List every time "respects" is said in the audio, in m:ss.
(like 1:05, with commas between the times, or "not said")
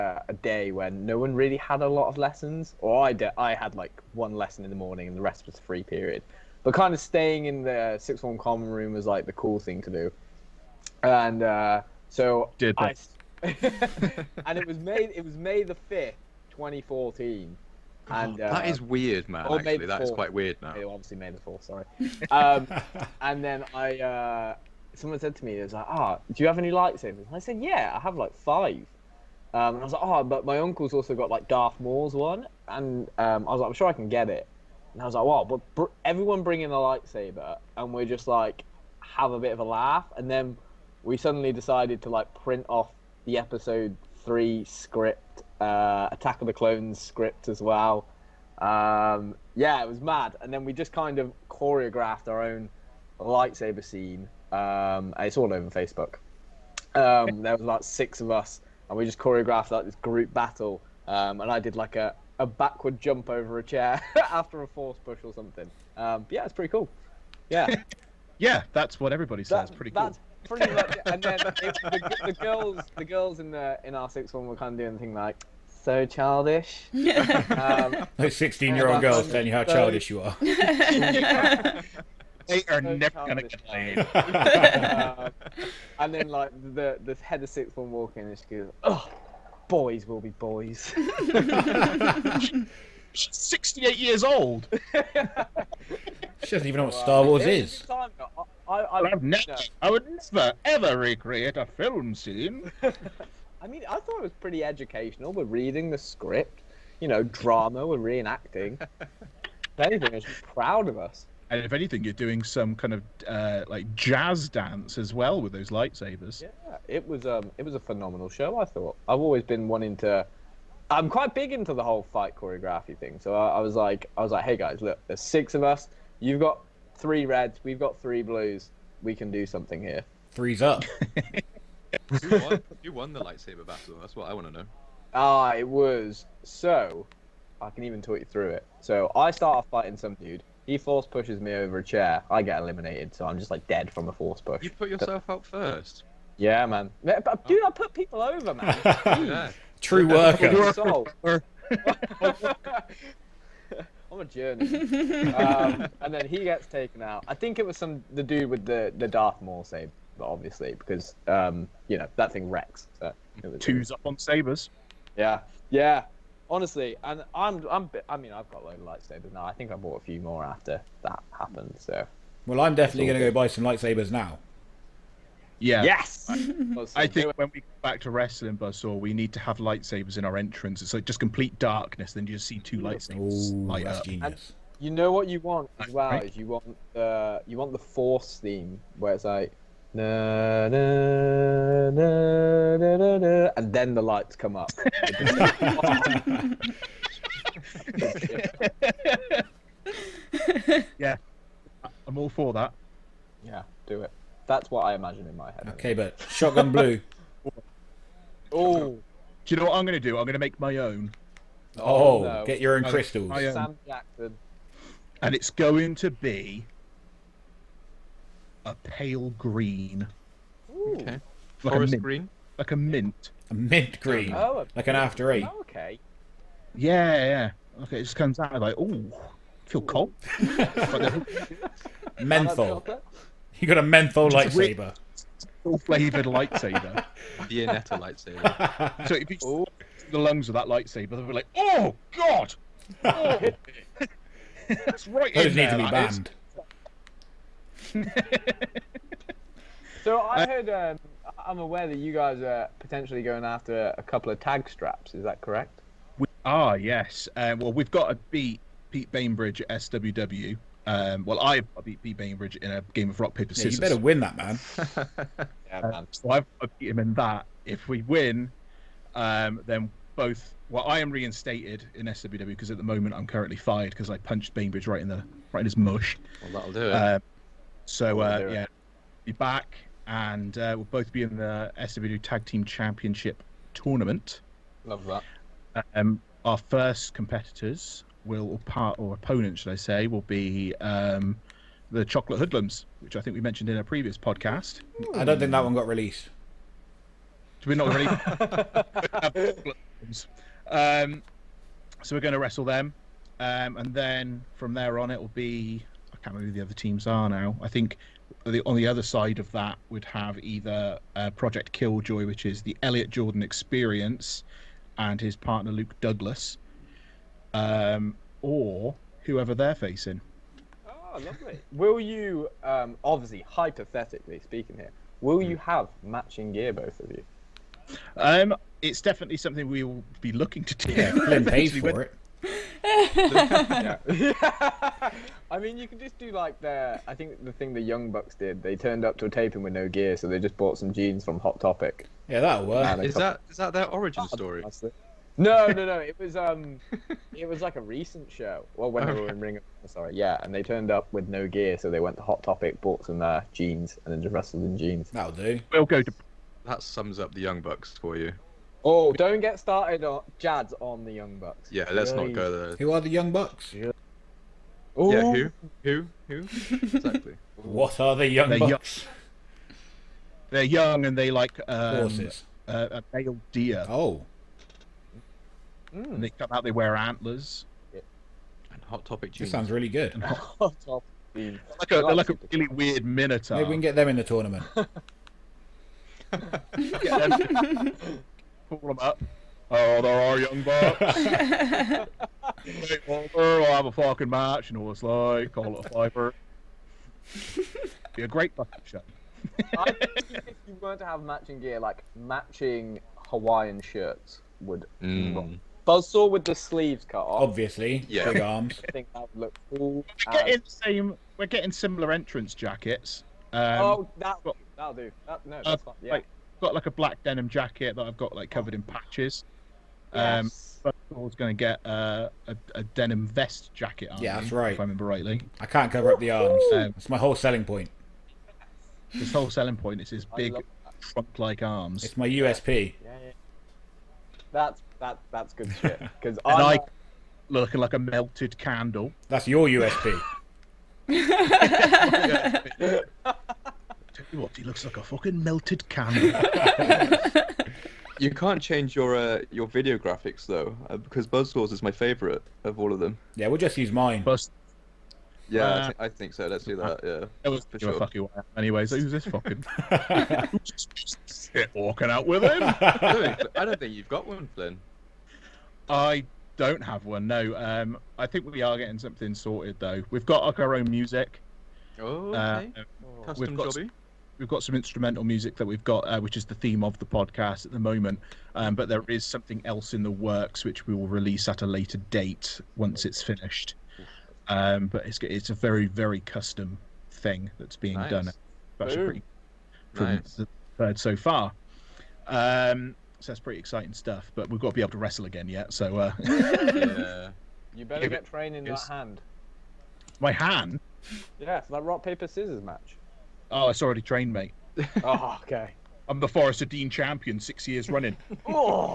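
not said.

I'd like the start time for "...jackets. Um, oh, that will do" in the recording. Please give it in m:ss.
6:52.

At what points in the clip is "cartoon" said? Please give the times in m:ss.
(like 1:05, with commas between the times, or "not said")
not said.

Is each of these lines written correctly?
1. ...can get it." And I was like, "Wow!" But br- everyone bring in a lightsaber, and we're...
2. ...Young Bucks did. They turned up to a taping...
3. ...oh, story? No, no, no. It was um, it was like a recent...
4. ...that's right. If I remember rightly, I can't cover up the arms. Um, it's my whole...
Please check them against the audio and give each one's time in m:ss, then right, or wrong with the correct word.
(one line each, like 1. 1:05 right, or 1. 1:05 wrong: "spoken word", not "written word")
1. 0:33 right
2. 5:37 right
3. 5:44 right
4. 7:04 right.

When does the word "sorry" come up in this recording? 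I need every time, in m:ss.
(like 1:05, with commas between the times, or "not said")
0:21, 5:49.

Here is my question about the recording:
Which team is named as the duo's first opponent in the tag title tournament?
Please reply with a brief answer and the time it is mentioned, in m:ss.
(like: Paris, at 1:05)
Chocolate Hoodlums, at 4:52.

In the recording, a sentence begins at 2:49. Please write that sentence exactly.
I think I bought a few more after that happened.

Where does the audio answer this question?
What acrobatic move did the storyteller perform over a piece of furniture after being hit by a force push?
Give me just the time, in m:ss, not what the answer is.
1:02.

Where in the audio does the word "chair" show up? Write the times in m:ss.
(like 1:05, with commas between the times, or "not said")
1:03, 2:21.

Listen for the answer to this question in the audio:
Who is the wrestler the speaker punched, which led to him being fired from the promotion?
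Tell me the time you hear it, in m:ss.
4:18.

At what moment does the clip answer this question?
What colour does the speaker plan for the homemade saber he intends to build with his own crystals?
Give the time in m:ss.
3:38.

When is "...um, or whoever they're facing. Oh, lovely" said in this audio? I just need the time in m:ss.
5:17.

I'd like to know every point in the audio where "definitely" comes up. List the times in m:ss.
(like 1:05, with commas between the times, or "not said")
2:52, 5:28.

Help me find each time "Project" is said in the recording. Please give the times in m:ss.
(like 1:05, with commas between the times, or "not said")
5:11.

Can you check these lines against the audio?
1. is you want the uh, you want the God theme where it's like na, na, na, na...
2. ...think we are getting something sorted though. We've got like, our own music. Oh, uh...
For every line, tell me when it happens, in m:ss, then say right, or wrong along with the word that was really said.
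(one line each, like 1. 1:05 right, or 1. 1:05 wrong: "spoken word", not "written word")
1. 3:06 wrong: "Force", not "God"
2. 7:48 right.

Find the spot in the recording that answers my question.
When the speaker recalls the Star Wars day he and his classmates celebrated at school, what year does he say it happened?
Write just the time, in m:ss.
0:16.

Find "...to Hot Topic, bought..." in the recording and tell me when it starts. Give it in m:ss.
5:52.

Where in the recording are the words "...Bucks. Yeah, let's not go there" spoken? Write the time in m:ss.
6:01.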